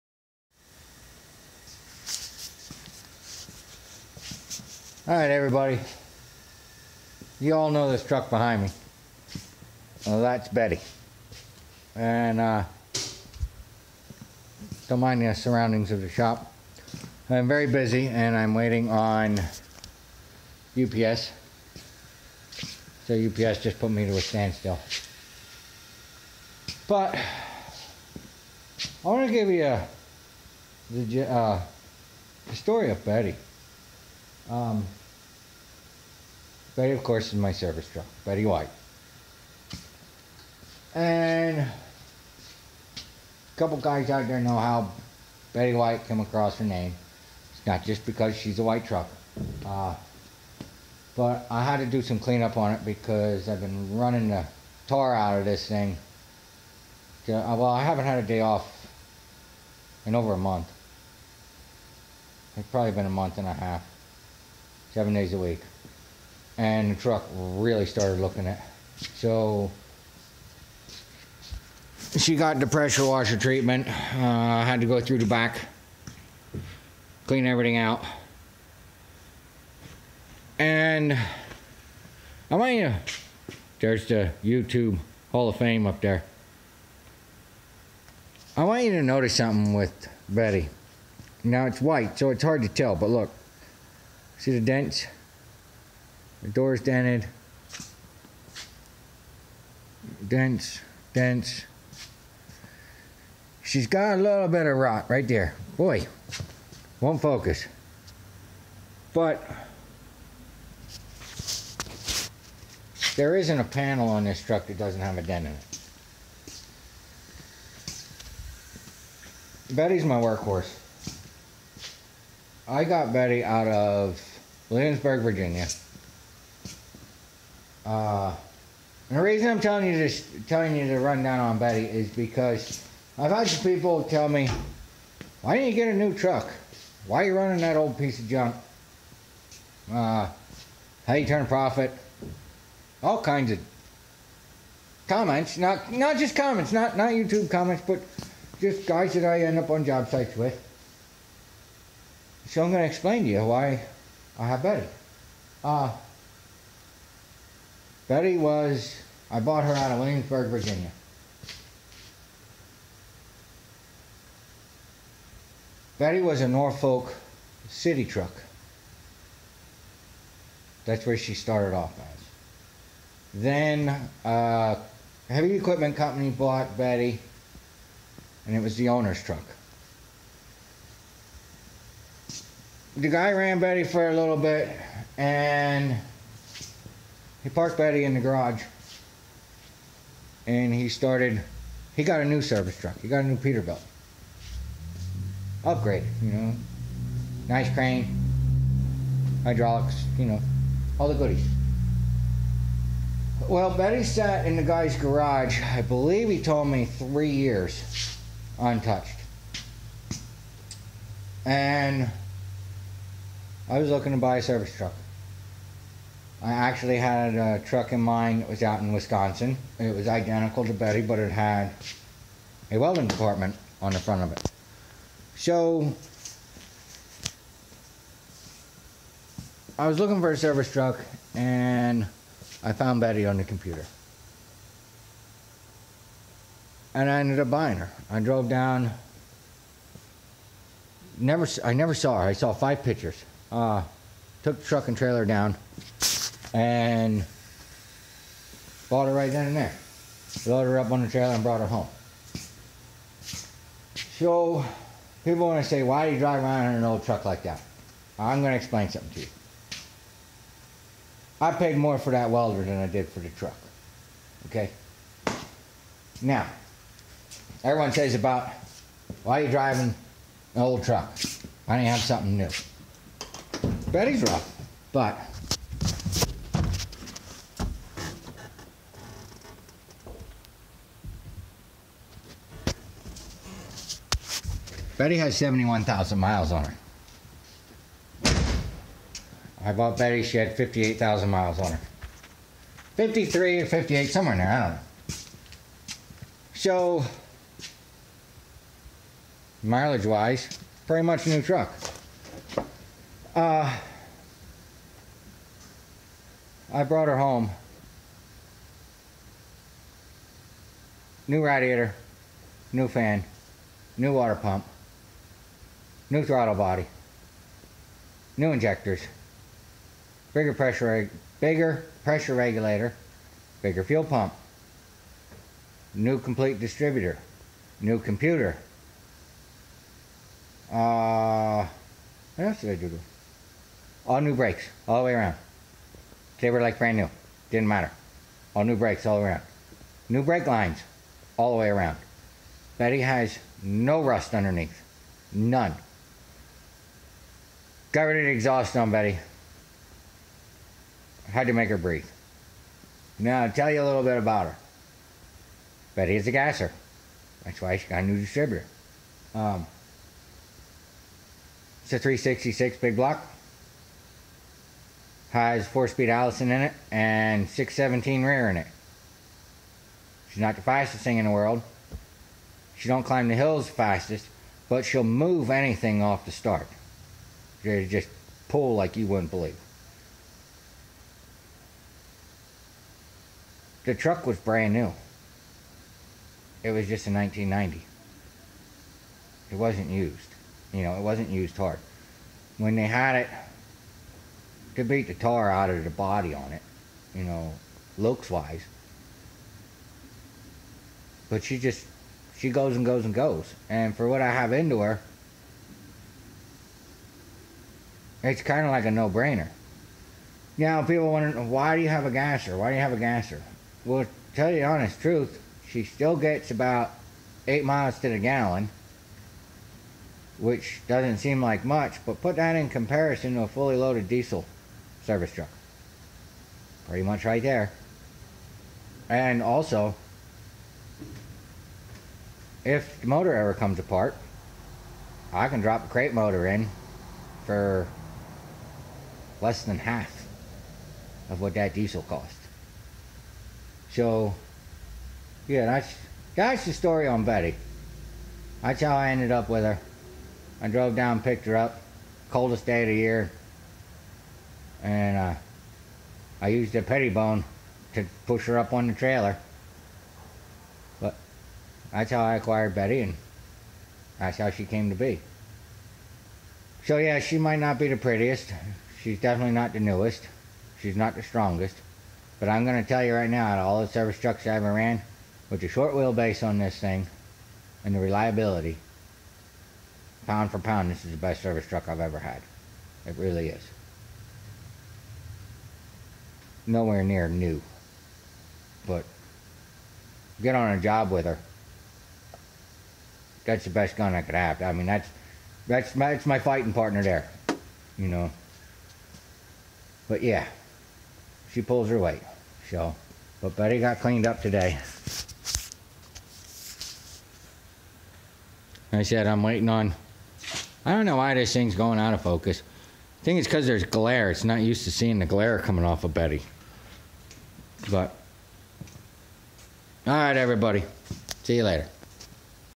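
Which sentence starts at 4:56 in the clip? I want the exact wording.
So, mileage wise, pretty much new truck.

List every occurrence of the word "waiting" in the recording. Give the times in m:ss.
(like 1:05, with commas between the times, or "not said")
0:18, 8:29.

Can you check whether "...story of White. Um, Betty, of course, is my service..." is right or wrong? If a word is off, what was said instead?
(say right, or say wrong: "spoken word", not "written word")
wrong: "Betty", not "White".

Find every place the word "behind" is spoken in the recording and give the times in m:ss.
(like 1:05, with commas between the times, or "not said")
0:08.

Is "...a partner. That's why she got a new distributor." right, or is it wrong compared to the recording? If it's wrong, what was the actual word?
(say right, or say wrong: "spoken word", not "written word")
wrong: "gasser", not "partner".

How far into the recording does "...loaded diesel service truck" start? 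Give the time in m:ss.
7:03.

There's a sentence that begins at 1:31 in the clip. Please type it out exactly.
Now it's white, so it's hard to tell, but look.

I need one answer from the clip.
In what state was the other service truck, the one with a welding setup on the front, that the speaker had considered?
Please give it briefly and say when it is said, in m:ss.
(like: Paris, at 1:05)
Wisconsin, at 3:38.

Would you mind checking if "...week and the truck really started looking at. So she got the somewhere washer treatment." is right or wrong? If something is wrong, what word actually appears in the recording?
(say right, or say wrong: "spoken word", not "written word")
wrong: "pressure", not "somewhere".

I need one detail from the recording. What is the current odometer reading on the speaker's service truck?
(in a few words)
71,000 miles.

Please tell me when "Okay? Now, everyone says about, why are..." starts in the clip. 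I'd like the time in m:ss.
4:24.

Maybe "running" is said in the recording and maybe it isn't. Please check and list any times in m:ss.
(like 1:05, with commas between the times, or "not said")
0:53, 2:17.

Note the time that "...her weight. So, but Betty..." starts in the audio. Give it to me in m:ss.
8:21.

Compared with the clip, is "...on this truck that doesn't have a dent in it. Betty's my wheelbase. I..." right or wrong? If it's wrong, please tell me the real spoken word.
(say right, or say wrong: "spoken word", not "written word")
wrong: "workhorse", not "wheelbase".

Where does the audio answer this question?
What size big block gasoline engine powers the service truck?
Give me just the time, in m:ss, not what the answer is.
6:01.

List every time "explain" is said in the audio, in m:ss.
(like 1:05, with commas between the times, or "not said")
2:32, 4:18.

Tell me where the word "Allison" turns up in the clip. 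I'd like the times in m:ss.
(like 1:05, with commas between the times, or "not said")
6:06.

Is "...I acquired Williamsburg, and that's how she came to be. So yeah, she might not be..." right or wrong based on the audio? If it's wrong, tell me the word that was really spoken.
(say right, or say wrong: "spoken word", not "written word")
wrong: "Betty", not "Williamsburg".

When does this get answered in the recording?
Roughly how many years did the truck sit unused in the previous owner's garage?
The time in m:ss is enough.
3:26.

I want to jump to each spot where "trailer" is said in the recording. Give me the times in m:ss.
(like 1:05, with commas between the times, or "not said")
4:04, 4:11, 7:38.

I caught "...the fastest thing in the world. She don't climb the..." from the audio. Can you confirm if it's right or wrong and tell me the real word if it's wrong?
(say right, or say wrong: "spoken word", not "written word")
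right.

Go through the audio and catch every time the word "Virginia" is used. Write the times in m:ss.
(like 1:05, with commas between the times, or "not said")
2:05, 2:40.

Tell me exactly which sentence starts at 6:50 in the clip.
Now, people wonder, why do you have a gasser?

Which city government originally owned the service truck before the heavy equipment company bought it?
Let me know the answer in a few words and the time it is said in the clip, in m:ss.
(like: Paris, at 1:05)
Norfolk, at 2:46.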